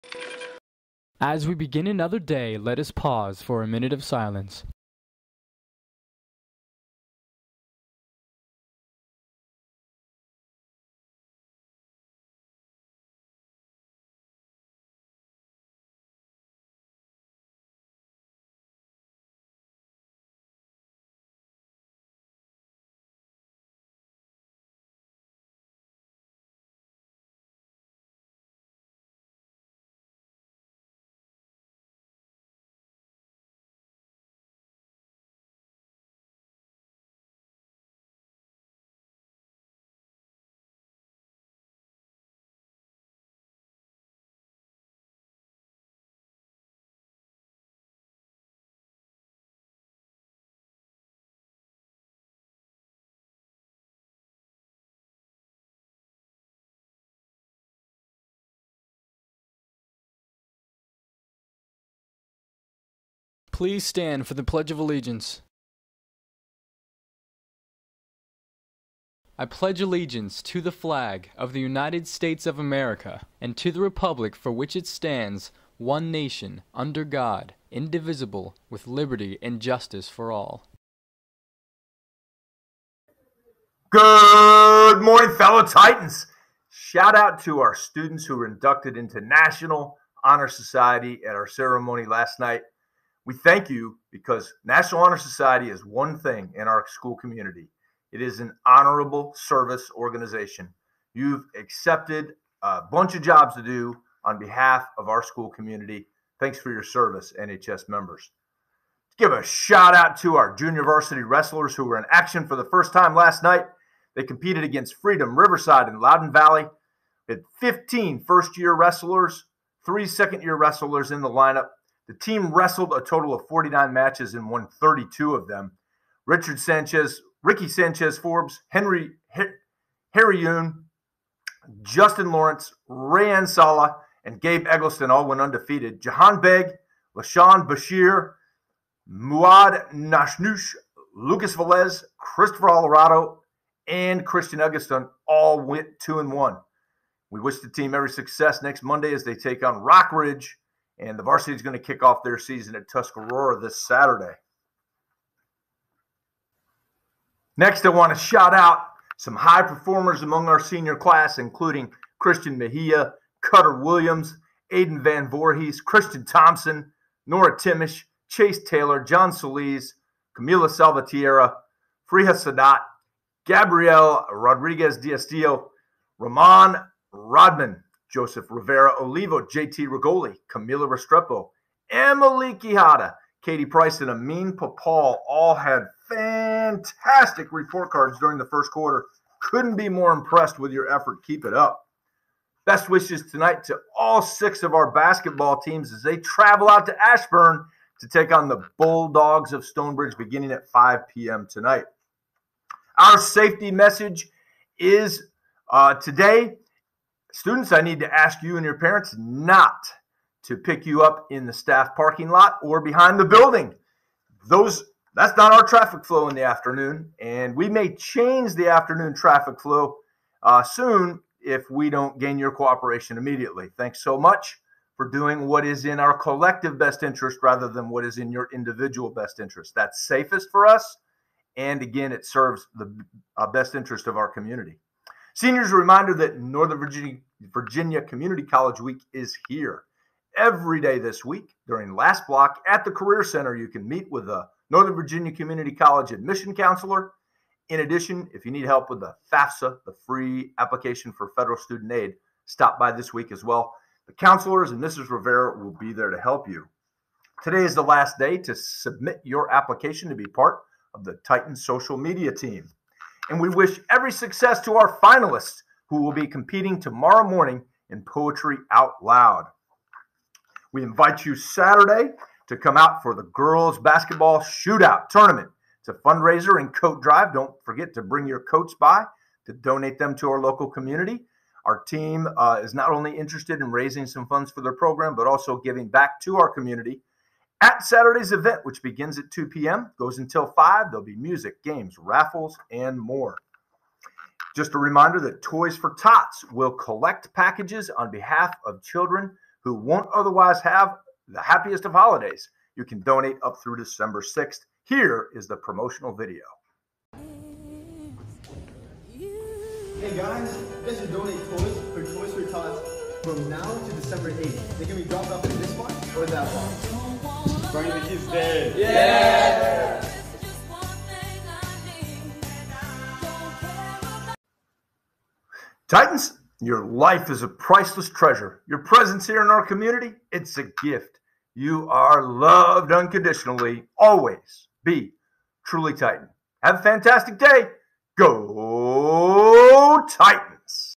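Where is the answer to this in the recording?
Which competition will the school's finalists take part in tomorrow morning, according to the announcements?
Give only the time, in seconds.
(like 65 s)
268 s.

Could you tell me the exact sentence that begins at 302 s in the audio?
You can donate up through December 6th.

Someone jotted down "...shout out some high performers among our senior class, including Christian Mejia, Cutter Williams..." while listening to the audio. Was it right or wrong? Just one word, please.
right.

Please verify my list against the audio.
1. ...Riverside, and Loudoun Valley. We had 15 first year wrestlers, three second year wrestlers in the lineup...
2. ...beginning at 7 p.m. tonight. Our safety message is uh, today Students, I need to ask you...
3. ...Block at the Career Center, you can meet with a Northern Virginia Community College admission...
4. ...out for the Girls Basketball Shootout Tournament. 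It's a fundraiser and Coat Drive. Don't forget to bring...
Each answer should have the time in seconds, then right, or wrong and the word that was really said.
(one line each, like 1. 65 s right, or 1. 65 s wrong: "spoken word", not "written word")
1. 115 s right
2. 200 s wrong: "5", not "7"
3. 242 s right
4. 272 s right.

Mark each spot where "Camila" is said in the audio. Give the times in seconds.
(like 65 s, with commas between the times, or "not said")
170 s, 180 s.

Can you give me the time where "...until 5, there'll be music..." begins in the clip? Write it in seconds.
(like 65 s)
290 s.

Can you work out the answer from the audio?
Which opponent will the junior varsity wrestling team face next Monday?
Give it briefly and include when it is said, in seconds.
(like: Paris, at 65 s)
Rock Ridge, at 149 s.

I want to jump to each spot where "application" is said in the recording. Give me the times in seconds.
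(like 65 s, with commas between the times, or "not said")
250 s, 259 s.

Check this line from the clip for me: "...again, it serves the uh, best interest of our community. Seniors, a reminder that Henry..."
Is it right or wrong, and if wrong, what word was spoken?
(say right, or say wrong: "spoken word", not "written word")
wrong: "Northern", not "Henry".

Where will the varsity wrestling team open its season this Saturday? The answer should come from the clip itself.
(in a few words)
Tuscarora.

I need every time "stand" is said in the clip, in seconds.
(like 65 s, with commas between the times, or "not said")
63 s, 74 s.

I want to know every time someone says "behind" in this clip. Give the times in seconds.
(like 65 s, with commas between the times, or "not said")
212 s.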